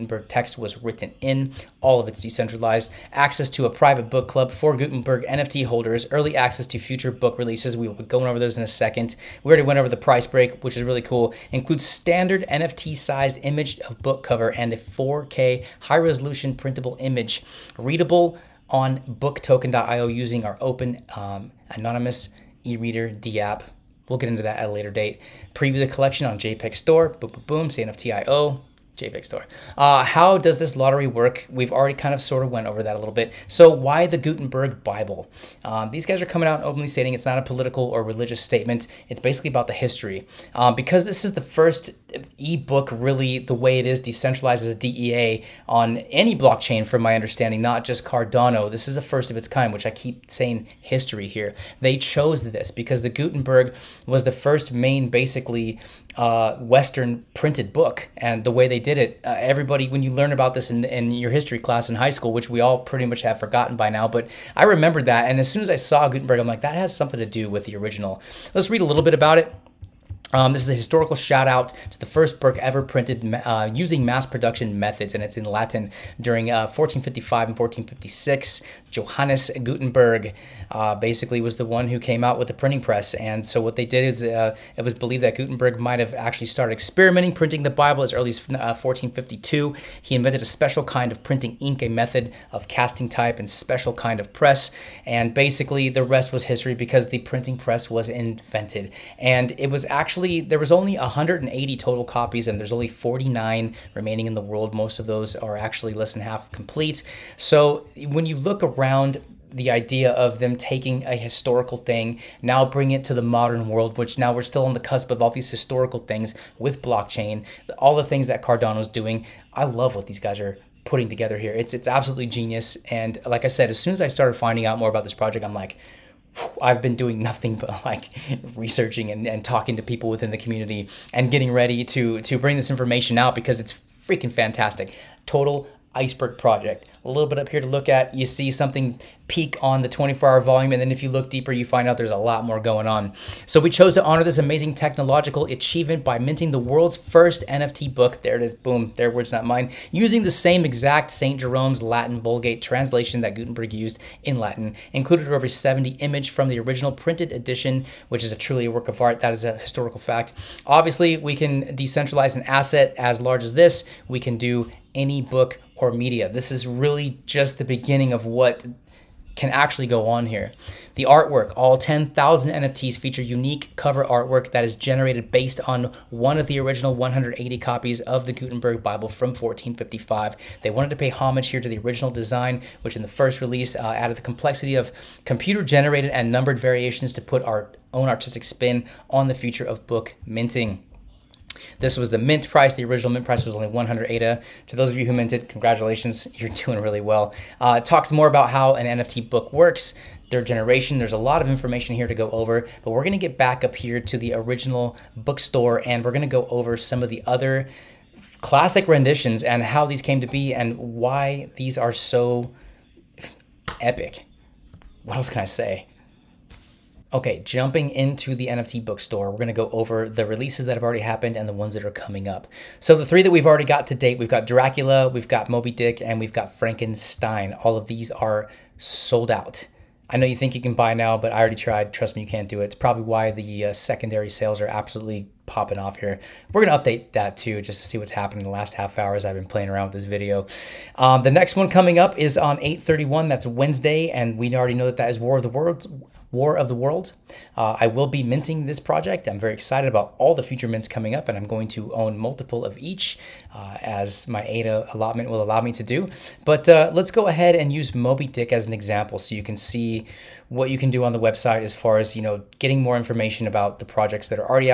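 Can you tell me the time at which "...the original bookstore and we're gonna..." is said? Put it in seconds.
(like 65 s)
204 s.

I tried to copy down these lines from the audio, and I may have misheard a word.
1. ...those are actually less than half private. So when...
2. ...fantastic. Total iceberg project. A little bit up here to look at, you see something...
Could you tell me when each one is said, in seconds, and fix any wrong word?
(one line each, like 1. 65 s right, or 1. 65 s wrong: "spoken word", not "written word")
1. 105 s wrong: "complete", not "private"
2. 134 s right.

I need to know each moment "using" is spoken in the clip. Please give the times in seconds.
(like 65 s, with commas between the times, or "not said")
20 s, 73 s, 149 s.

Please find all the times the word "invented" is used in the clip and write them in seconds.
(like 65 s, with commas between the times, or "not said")
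90 s, 98 s.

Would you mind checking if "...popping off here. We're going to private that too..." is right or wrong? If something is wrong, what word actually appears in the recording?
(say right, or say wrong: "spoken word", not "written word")
wrong: "update", not "private".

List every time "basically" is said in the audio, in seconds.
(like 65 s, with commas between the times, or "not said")
39 s, 55 s, 80 s, 95 s.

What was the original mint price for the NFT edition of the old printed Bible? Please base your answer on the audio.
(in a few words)
100 ADA.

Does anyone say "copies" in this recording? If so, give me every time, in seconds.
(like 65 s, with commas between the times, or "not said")
102 s, 177 s.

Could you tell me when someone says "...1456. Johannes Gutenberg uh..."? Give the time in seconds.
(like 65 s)
77 s.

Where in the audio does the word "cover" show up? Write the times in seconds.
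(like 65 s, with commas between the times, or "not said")
14 s, 173 s.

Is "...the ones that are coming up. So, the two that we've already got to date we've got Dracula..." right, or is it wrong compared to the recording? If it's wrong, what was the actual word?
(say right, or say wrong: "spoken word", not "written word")
wrong: "three", not "two".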